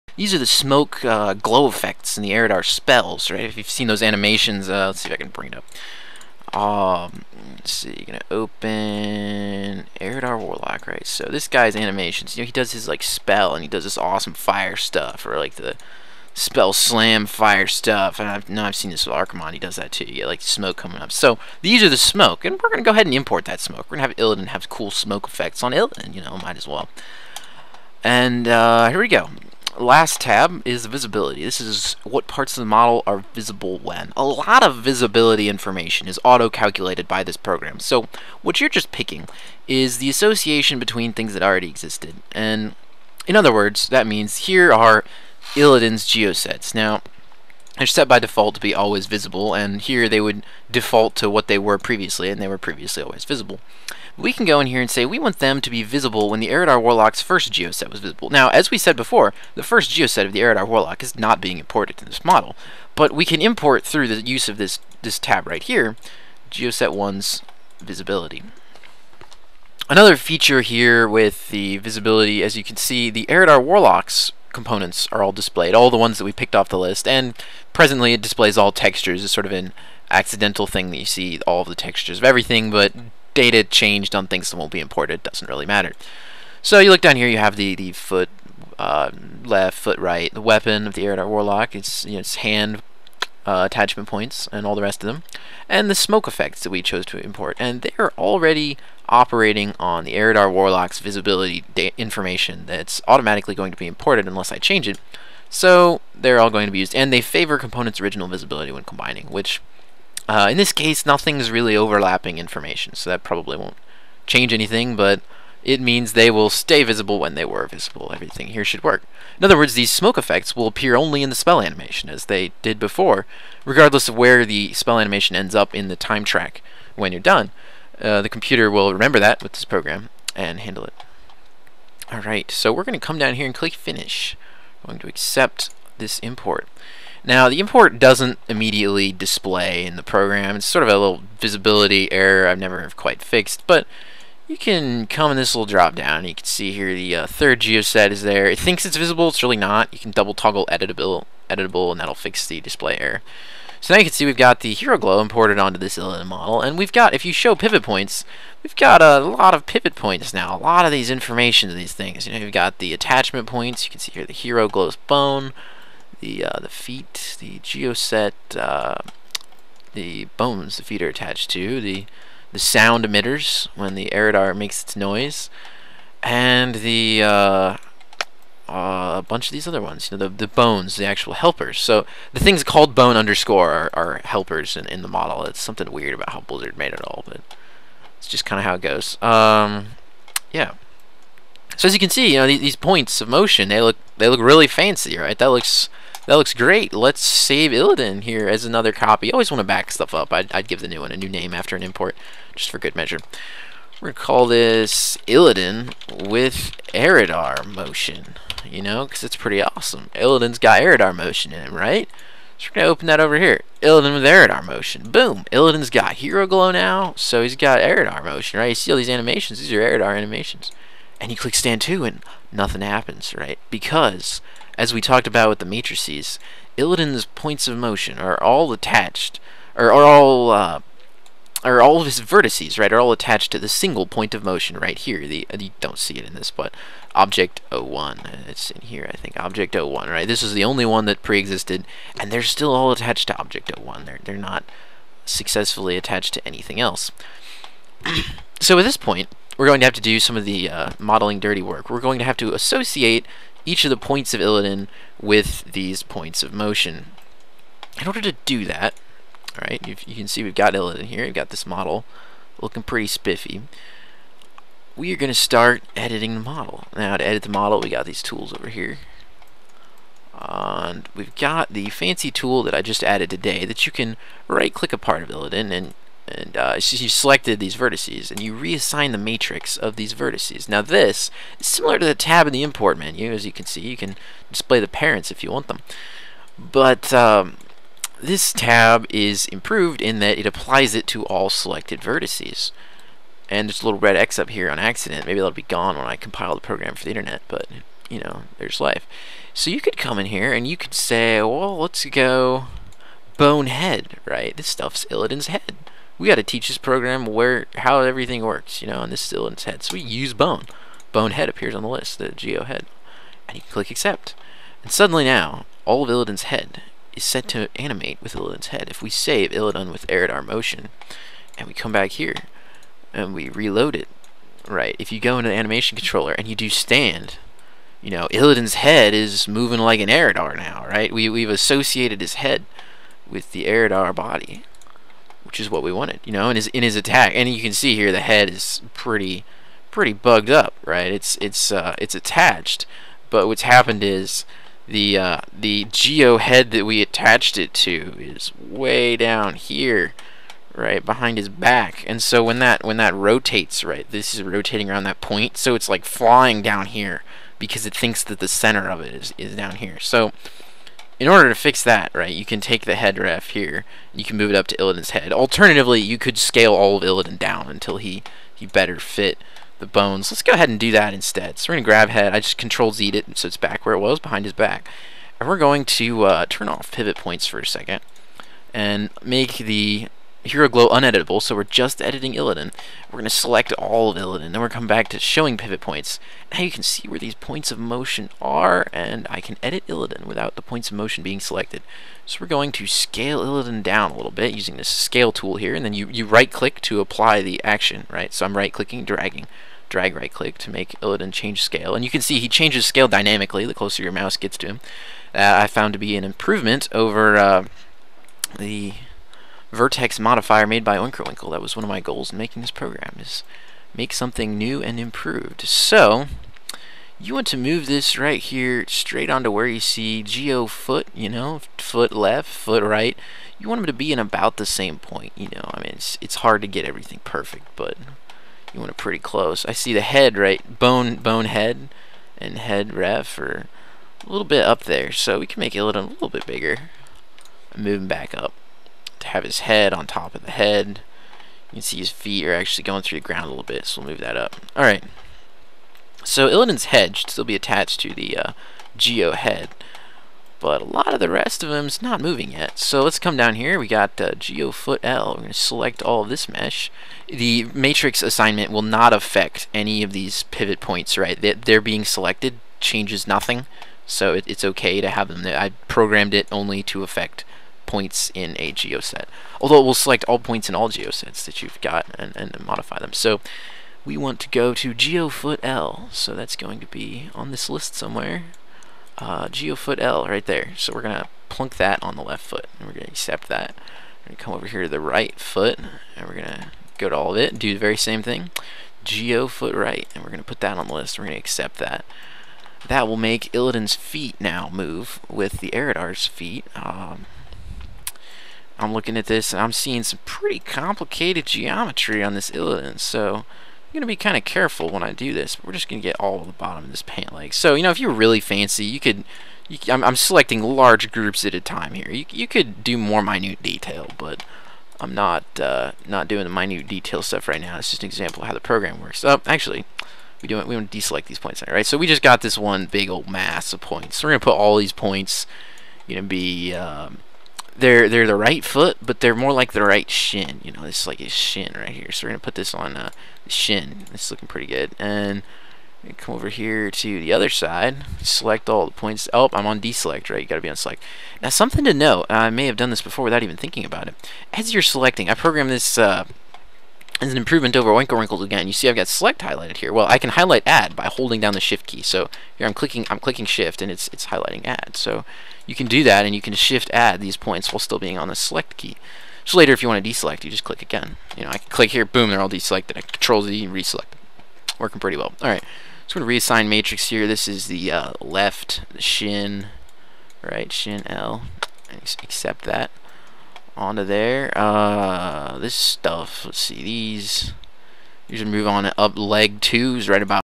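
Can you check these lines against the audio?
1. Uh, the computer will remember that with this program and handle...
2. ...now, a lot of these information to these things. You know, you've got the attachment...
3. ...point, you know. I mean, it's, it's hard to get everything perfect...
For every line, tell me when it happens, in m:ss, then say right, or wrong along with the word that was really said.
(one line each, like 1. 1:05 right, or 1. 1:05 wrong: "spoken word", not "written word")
1. 2:08 right
2. 2:40 right
3. 7:04 right.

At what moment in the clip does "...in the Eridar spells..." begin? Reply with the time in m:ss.
0:02.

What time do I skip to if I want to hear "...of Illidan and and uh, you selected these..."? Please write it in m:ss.
4:35.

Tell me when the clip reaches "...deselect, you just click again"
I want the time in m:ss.
9:20.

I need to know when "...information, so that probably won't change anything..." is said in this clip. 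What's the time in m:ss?
1:52.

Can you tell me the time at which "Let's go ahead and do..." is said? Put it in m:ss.
6:10.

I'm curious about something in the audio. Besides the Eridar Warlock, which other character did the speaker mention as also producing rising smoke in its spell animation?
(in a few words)
Archimonde.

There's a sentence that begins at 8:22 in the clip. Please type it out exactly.
so I'm going to be kind of careful when I do this.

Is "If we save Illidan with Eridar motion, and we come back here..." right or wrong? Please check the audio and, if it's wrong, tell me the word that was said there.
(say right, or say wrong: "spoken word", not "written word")
right.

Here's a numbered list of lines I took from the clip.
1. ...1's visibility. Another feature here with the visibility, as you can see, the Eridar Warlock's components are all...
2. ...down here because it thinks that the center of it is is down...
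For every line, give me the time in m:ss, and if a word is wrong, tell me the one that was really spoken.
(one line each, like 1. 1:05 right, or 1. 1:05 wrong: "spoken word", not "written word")
1. 1:06 right
2. 5:56 right.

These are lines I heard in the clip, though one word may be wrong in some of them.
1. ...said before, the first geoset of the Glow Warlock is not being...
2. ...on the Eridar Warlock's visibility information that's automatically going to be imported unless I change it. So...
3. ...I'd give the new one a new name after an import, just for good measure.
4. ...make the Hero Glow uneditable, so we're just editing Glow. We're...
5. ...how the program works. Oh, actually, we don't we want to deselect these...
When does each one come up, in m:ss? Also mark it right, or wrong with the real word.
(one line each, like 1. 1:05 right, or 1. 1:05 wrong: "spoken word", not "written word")
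1. 0:58 wrong: "Eridar", not "Glow"
2. 1:39 right
3. 3:20 right
4. 6:19 wrong: "Illidan", not "Glow"
5. 8:38 right.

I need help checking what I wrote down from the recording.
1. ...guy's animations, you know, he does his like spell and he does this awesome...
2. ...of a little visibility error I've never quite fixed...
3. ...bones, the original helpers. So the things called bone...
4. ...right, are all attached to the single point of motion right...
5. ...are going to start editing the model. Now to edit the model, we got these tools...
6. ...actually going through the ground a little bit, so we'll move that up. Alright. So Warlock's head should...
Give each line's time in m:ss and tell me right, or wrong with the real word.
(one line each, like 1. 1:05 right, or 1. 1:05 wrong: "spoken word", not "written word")
1. 0:11 right
2. 2:20 right
3. 3:00 wrong: "actual", not "original"
4. 3:52 right
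5. 4:25 right
6. 7:22 wrong: "Illidan", not "Warlock".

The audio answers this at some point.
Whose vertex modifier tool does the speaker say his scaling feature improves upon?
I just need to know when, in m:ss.
6:50.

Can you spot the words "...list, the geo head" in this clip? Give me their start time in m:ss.
5:11.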